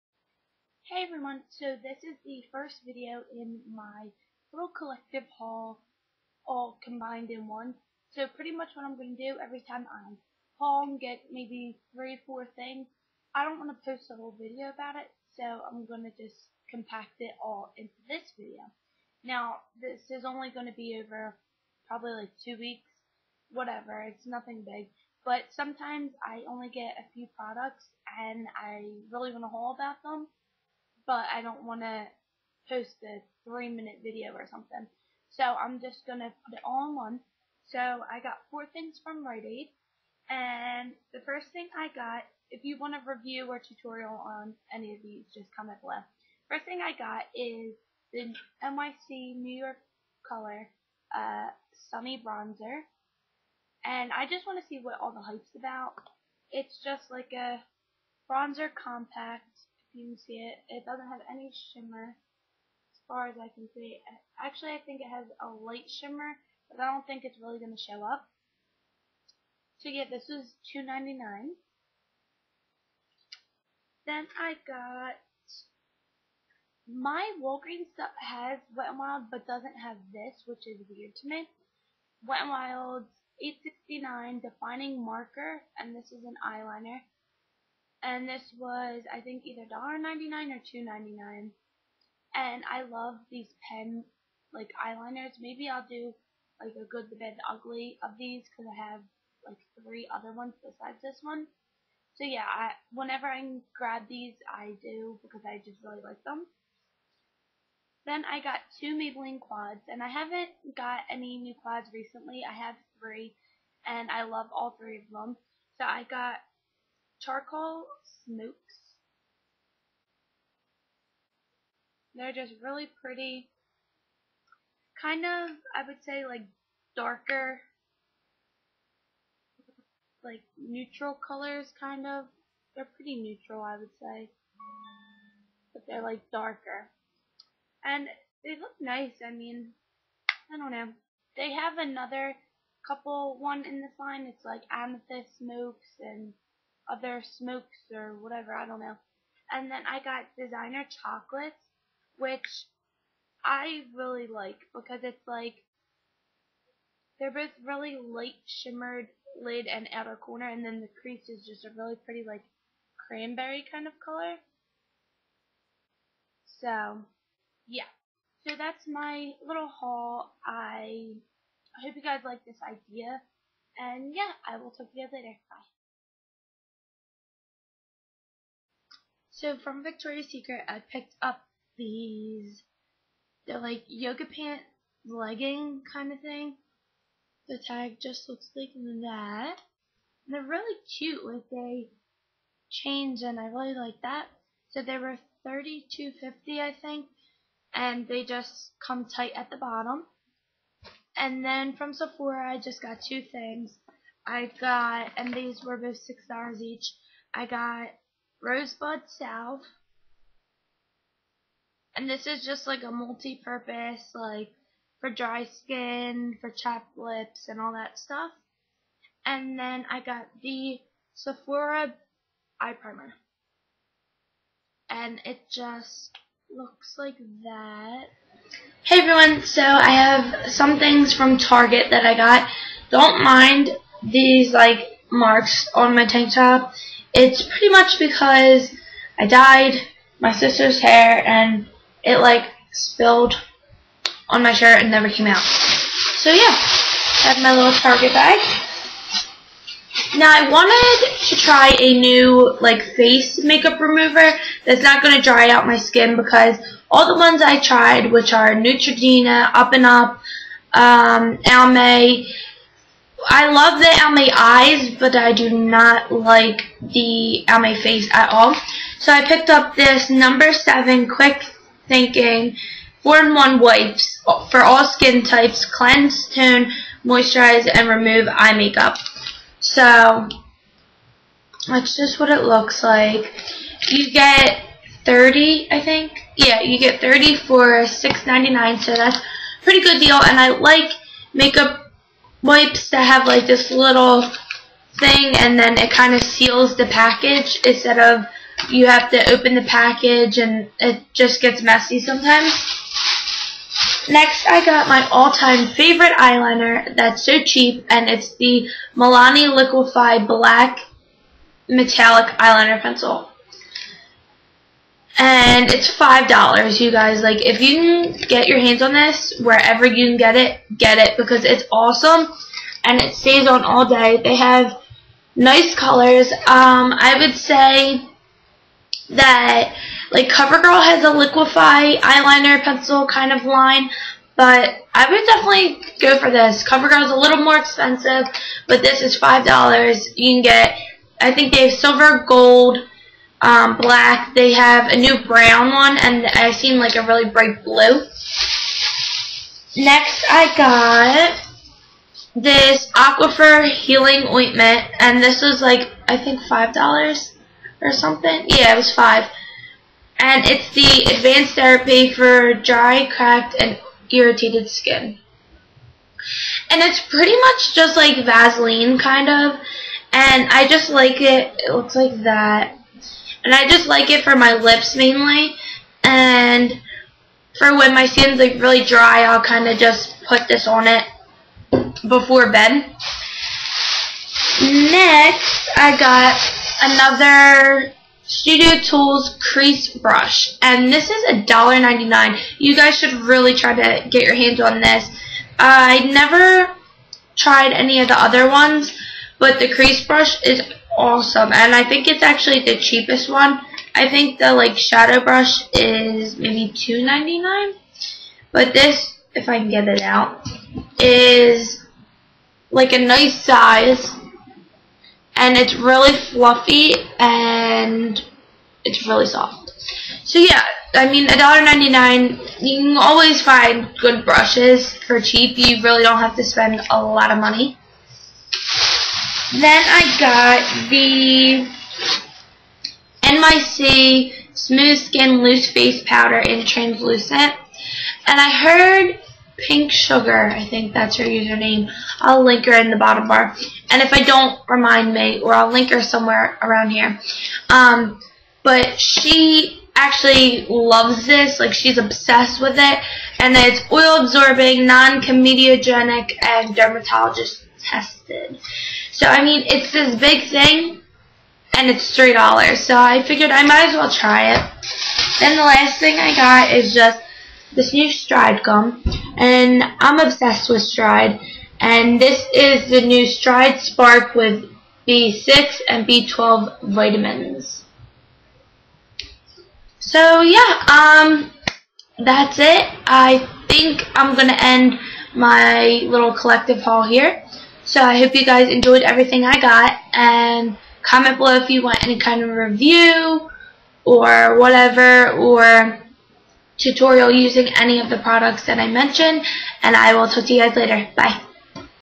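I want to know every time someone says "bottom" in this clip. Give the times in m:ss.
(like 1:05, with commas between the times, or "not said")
3:19, 7:22.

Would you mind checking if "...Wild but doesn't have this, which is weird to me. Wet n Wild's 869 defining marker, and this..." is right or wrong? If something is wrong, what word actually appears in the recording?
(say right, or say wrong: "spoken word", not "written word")
right.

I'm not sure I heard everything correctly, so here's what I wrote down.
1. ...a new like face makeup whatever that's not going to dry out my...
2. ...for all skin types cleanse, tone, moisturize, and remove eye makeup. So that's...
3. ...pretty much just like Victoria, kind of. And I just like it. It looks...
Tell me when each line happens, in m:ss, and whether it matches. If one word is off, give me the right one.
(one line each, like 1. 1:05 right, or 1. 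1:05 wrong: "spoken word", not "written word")
1. 4:11 wrong: "remover", not "whatever"
2. 4:34 right
3. 6:07 wrong: "Vaseline", not "Victoria".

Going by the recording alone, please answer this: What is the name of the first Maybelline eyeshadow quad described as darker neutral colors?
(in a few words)
Charcoal Smokes.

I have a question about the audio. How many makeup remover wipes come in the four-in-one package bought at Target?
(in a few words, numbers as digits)
30.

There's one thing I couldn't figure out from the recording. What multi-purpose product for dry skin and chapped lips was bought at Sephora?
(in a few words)
Rosebud Salve.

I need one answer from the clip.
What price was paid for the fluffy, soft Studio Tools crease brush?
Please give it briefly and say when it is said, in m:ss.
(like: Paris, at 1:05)
$1.99, at 6:31.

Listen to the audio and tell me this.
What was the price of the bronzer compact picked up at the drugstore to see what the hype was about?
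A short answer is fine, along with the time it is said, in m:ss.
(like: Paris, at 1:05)
$2.99, at 1:10.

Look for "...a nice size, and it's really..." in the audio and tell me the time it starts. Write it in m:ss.
6:52.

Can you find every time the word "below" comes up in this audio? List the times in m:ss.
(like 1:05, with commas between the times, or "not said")
0:45, 8:11.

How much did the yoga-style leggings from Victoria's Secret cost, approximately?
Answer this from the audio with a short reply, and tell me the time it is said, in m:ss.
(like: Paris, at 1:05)
$32.50, at 3:15.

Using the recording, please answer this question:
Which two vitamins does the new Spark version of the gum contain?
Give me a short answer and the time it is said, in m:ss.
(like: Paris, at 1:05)
B6 and B12, at 7:55.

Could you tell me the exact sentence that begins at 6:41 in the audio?
And I think it's actually the cheapest one.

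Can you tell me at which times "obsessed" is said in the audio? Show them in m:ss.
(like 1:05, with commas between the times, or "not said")
7:31, 7:50.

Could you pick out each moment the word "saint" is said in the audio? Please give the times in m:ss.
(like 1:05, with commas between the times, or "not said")
not said.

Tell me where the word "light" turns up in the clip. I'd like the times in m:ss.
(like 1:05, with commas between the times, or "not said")
1:05, 2:38.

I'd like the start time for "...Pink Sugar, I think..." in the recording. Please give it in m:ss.
7:19.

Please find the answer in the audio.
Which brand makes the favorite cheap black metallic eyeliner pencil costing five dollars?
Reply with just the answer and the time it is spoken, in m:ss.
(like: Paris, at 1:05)
Milani, at 5:08.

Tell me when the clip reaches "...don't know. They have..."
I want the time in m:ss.
2:20.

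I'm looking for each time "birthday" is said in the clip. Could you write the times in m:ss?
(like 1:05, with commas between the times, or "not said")
not said.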